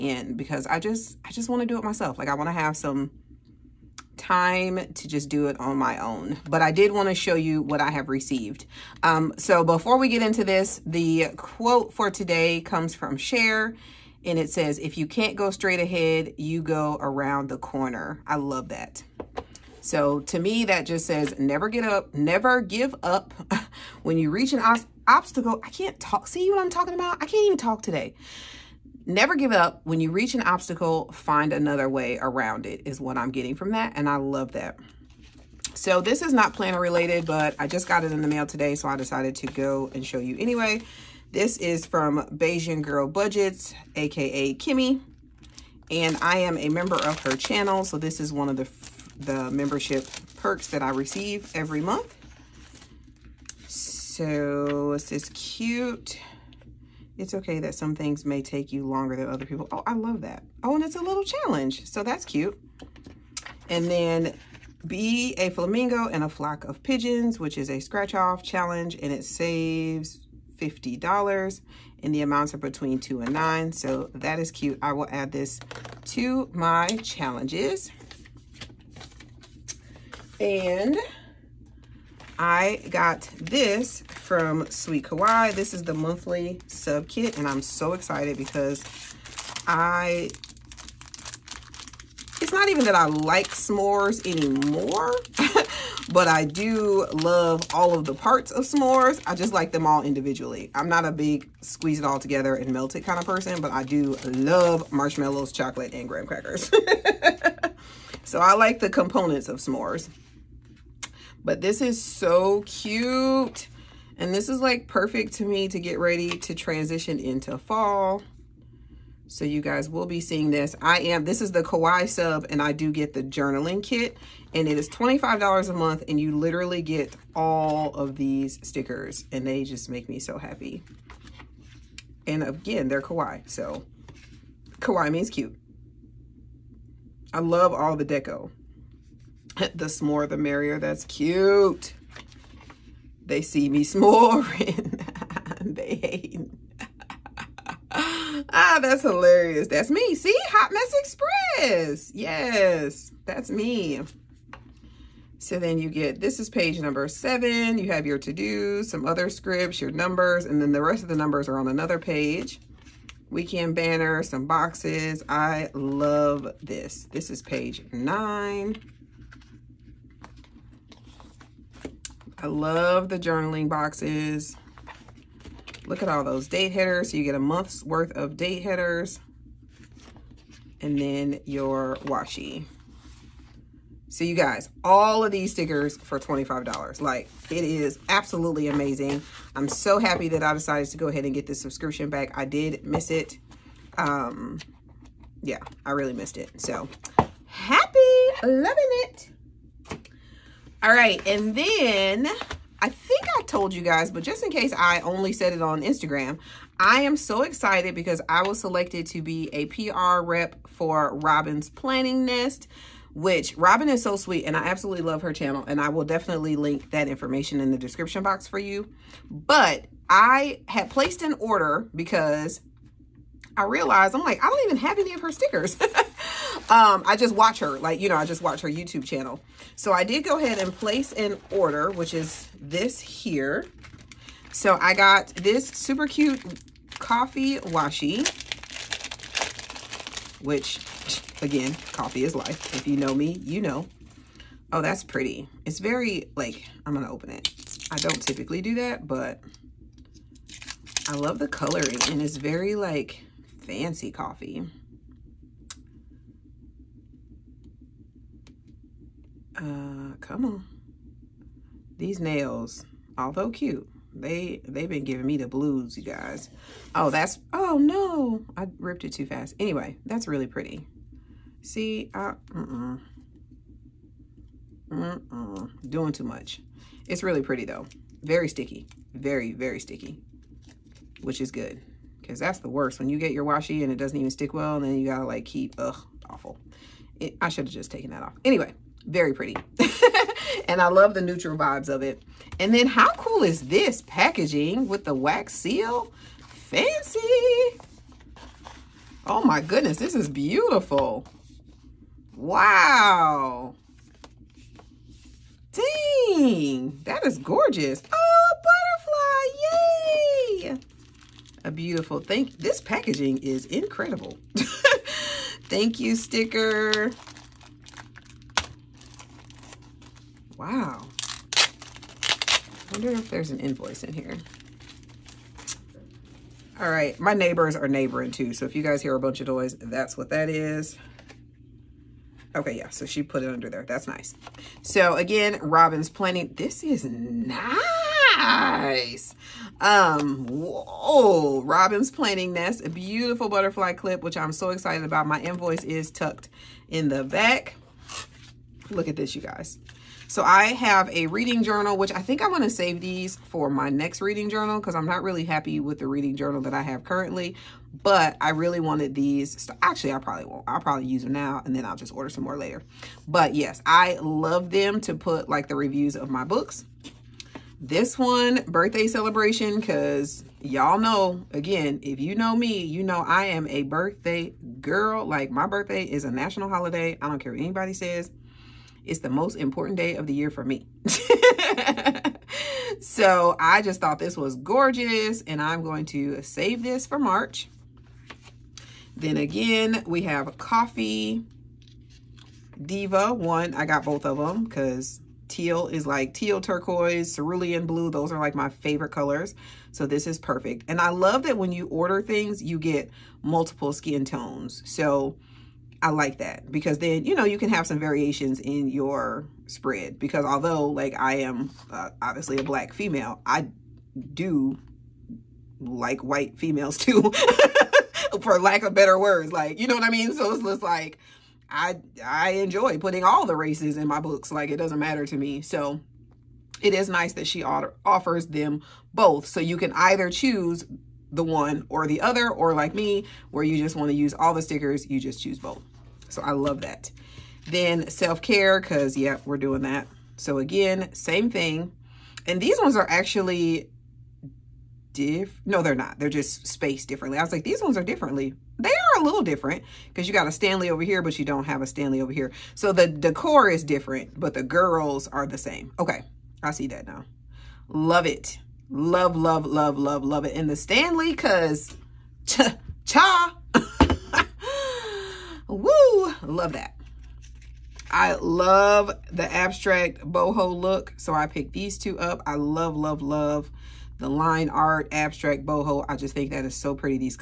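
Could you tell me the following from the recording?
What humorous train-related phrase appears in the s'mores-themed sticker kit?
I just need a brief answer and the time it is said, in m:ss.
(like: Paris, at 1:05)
Hot Mess Express, at 2:30.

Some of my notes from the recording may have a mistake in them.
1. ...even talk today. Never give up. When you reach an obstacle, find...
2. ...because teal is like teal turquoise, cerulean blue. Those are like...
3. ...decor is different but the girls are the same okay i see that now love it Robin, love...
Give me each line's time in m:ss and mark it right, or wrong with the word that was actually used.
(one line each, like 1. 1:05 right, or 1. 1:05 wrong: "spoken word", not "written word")
1. 0:27 right
2. 6:34 right
3. 7:33 wrong: "Love", not "Robin".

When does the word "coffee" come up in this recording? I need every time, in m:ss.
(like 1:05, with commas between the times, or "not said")
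3:56, 4:01, 4:14, 6:30.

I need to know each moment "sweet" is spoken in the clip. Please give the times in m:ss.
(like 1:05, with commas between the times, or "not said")
1:24, 3:34.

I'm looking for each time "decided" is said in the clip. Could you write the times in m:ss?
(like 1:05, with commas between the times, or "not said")
0:38, 3:10.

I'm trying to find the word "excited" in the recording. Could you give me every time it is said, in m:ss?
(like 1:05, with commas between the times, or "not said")
1:27, 3:27, 5:44.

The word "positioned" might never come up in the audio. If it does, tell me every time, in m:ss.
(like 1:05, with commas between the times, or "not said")
not said.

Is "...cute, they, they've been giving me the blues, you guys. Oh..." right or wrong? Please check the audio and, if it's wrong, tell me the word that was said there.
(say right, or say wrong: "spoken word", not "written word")
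right.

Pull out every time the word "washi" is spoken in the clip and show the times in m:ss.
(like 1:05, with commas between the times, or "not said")
3:02, 3:57, 4:43.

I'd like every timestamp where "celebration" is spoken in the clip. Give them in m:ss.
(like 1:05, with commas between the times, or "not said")
6:09.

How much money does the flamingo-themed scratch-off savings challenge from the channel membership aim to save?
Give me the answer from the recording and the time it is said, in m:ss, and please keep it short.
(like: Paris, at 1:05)
$50, at 1:10.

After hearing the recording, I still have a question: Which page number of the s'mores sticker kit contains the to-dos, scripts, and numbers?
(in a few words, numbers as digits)
7.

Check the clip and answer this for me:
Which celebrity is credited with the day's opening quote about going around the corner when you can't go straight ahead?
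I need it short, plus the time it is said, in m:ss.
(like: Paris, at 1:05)
Cher, at 0:13.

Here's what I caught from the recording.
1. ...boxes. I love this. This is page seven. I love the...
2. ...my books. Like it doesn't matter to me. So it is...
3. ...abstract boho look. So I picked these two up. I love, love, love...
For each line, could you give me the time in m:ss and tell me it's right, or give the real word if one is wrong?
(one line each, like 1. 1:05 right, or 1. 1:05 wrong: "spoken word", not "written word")
1. 2:44 wrong: "nine", not "seven"
2. 7:04 right
3. 7:49 right.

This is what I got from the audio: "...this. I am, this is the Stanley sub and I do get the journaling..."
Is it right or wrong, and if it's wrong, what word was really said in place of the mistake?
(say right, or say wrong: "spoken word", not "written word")
wrong: "Kawaii", not "Stanley".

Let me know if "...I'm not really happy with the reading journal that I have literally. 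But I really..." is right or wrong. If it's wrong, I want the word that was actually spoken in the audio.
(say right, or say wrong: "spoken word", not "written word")
wrong: "currently", not "literally".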